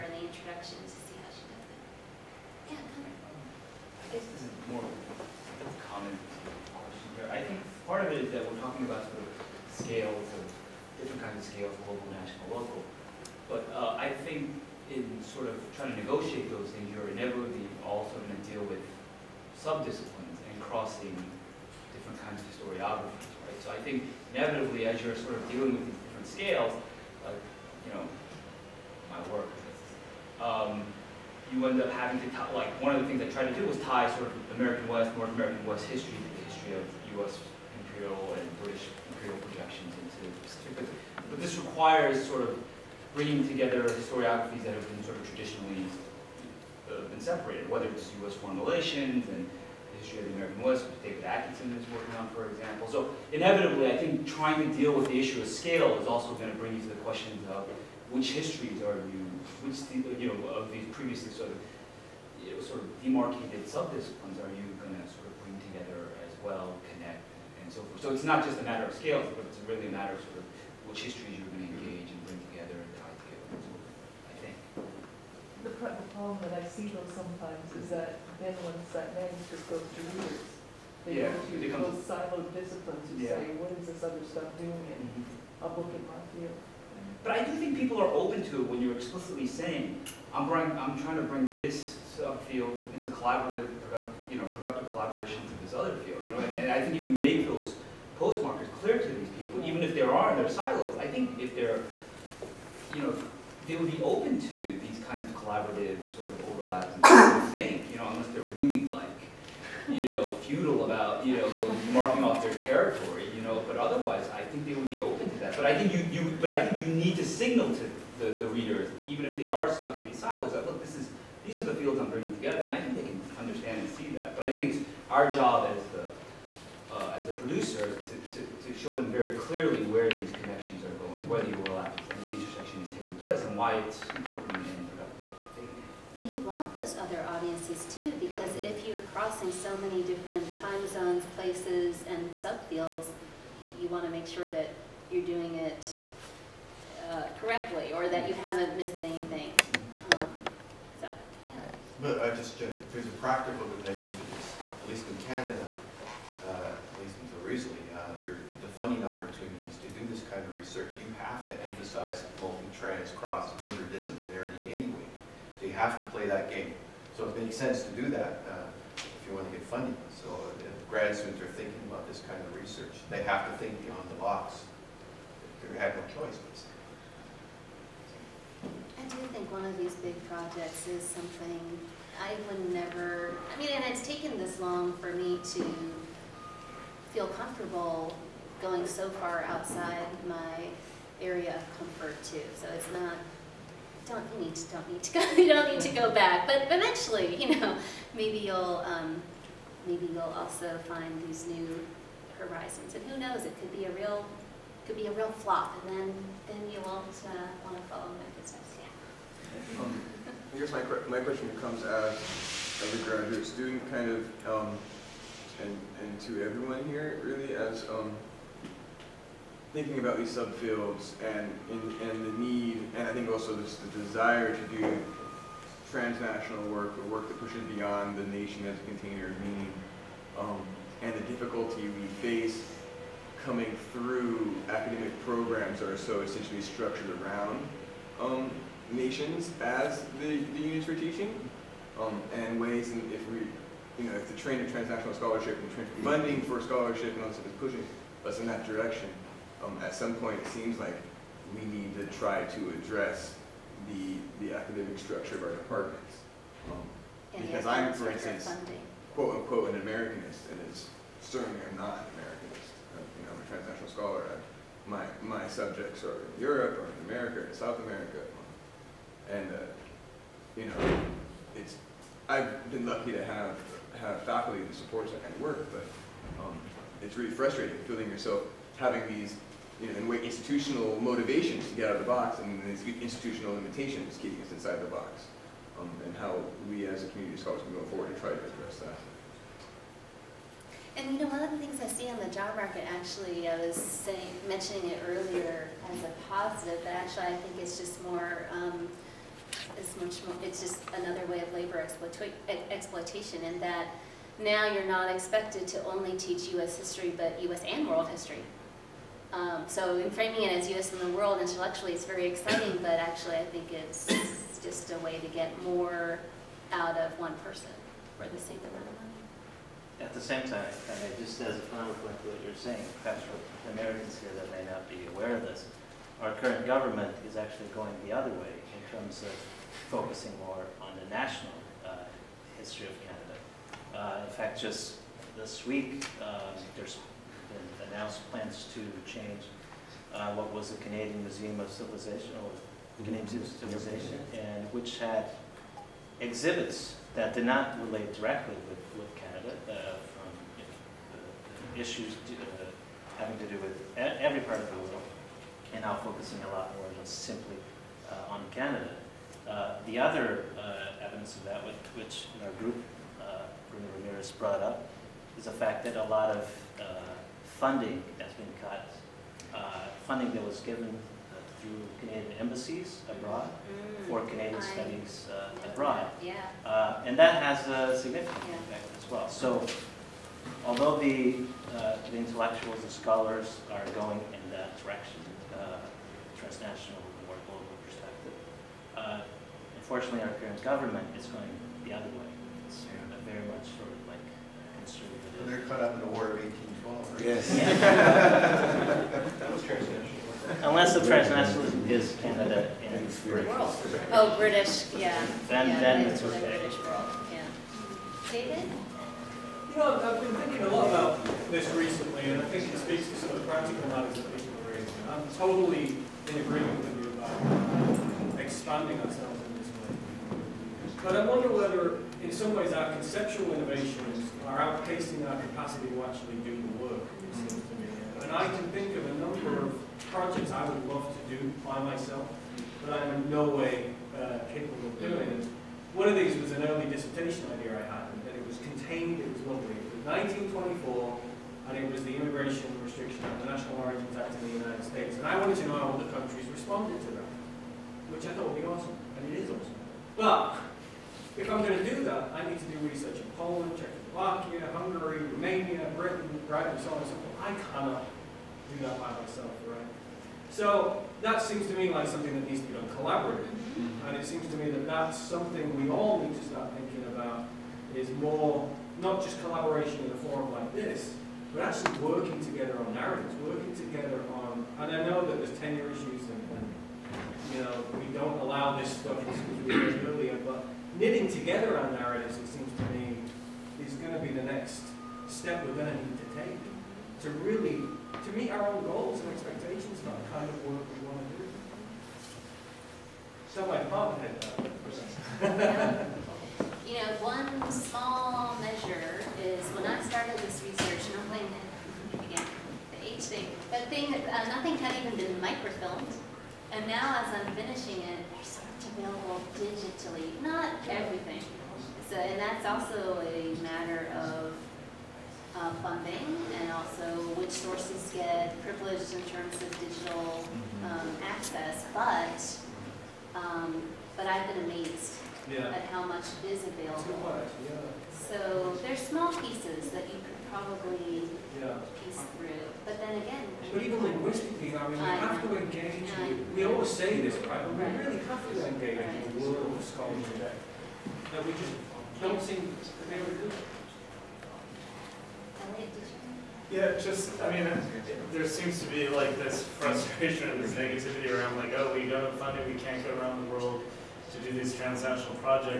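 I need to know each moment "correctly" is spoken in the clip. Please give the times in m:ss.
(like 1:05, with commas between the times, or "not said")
2:27.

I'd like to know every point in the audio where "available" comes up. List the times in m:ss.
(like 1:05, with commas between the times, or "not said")
8:28, 8:46.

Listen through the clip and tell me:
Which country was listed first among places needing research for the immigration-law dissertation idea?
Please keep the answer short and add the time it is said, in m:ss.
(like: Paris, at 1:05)
Poland, at 7:33.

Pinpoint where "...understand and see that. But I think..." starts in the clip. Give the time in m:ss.
2:03.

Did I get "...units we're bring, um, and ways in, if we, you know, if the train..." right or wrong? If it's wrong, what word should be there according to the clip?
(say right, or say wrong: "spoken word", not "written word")
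wrong: "teaching", not "bring".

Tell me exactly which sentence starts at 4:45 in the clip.
Um, and how we as a community of scholars can go forward and try to address that.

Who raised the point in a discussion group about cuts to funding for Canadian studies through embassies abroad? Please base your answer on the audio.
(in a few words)
Bruno Ramirez.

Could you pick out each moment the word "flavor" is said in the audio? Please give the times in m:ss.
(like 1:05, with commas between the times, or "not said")
not said.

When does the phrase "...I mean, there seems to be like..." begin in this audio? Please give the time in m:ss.
9:07.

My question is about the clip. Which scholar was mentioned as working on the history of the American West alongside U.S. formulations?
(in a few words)
David Atkinson.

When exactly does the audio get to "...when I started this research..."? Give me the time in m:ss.
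8:19.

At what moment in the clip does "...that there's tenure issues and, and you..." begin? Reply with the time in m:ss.
7:55.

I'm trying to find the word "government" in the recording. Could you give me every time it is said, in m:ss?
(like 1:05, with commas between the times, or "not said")
5:26, 6:30.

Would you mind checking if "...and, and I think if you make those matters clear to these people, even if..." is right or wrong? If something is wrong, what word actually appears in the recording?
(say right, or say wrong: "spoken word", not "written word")
wrong: "postmarkers", not "matters".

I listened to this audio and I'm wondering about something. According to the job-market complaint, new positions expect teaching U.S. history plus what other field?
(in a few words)
World history.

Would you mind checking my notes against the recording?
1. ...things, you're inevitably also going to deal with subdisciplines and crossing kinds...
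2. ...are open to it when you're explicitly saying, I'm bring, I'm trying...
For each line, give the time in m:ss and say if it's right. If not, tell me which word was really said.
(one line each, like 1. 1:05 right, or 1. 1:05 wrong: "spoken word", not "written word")
1. 0:16 right
2. 1:28 right.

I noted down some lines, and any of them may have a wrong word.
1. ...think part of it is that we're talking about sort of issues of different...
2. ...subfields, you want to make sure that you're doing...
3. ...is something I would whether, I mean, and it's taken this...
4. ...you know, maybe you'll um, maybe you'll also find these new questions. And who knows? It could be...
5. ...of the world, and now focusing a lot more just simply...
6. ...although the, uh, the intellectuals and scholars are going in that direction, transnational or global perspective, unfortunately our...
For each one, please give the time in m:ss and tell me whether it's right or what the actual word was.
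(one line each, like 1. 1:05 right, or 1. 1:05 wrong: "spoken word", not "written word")
1. 0:07 wrong: "scales", not "issues"
2. 2:22 right
3. 3:00 wrong: "never", not "whether"
4. 3:17 wrong: "horizons", not "questions"
5. 5:54 right
6. 6:20 right.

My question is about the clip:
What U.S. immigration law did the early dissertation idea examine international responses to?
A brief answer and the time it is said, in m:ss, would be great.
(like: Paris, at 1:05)
National Origins Act, at 7:23.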